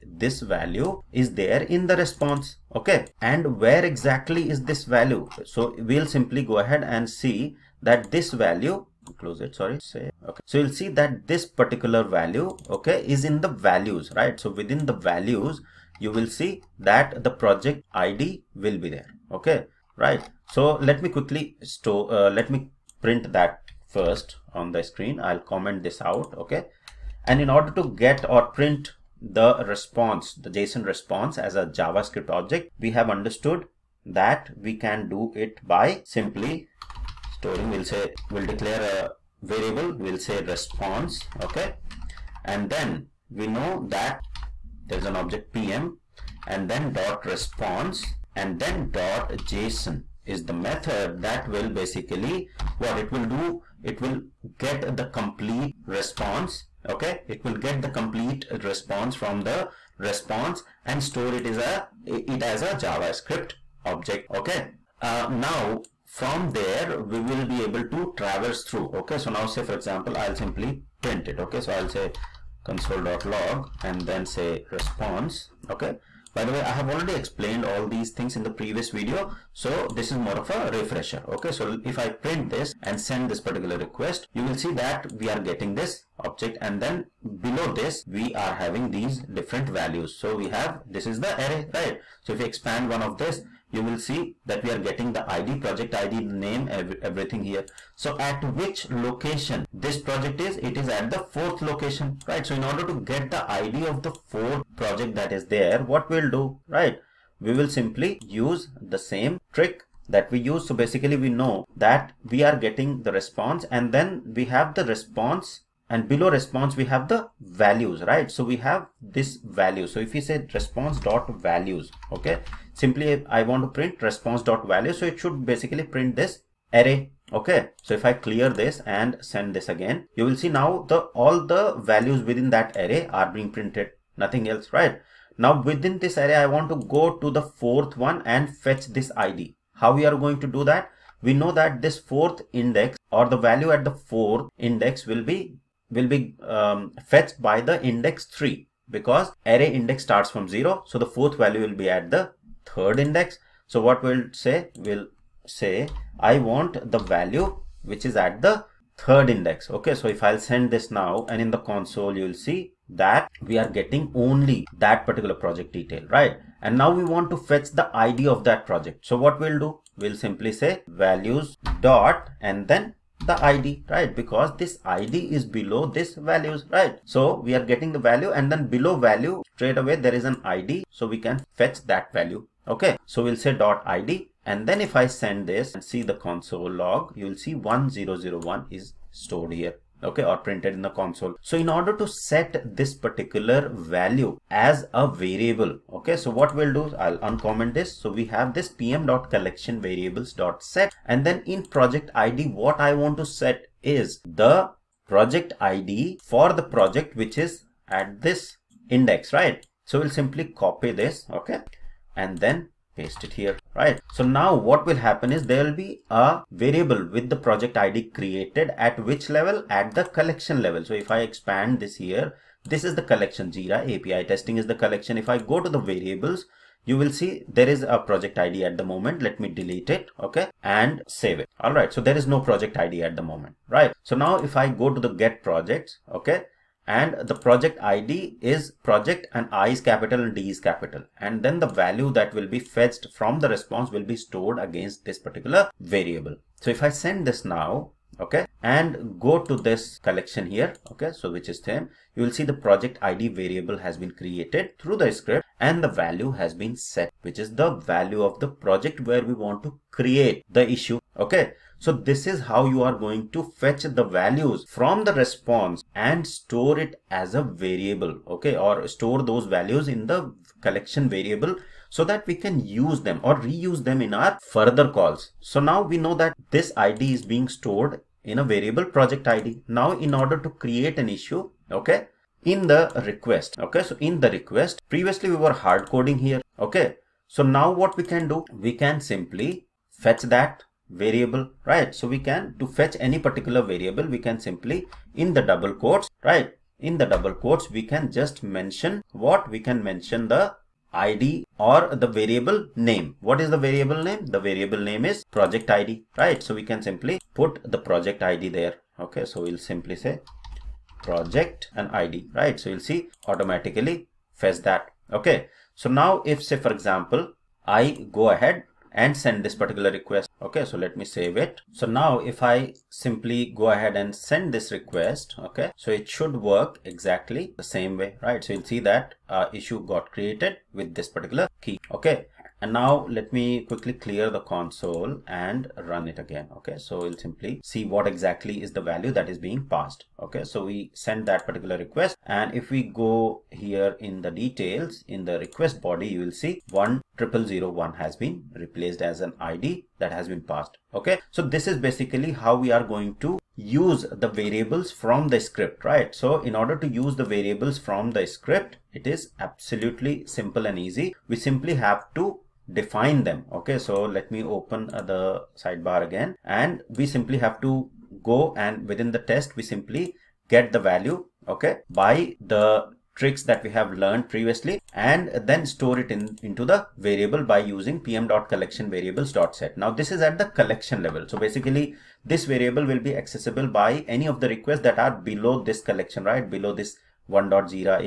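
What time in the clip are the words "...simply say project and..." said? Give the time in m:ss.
5:09.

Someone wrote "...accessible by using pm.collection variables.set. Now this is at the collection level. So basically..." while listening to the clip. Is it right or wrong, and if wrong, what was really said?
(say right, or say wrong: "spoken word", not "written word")
wrong: "variable", not "accessible".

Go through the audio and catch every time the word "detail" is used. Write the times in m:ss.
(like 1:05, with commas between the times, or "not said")
2:45, 5:44.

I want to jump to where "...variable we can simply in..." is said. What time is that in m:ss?
4:53.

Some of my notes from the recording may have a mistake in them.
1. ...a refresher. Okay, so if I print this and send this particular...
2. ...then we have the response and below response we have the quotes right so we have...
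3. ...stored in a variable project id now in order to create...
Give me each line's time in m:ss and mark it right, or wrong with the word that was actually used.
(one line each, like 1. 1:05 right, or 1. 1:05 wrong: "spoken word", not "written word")
1. 1:20 right
2. 1:53 wrong: "values", not "quotes"
3. 4:37 right.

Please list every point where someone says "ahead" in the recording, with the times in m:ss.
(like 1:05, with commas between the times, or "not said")
0:06, 5:18, 5:23.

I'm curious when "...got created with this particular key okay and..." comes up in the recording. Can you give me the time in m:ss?
5:29.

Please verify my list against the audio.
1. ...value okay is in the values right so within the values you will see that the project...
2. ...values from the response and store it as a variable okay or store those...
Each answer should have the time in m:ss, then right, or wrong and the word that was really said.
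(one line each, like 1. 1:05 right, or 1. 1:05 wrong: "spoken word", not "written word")
1. 0:12 right
2. 4:24 right.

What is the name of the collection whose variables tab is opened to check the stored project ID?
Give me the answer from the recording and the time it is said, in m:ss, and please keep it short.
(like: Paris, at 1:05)
jira api testing, at 3:43.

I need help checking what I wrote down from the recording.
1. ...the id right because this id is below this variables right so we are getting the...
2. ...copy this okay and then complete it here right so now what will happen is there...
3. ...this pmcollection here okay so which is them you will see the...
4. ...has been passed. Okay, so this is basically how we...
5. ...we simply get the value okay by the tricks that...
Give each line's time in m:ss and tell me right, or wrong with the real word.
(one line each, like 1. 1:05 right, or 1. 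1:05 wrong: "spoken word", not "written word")
1. 2:53 wrong: "values", not "variables"
2. 3:30 wrong: "paste", not "complete"
3. 4:09 wrong: "collection", not "pmcollection"
4. 5:50 right
5. 6:09 right.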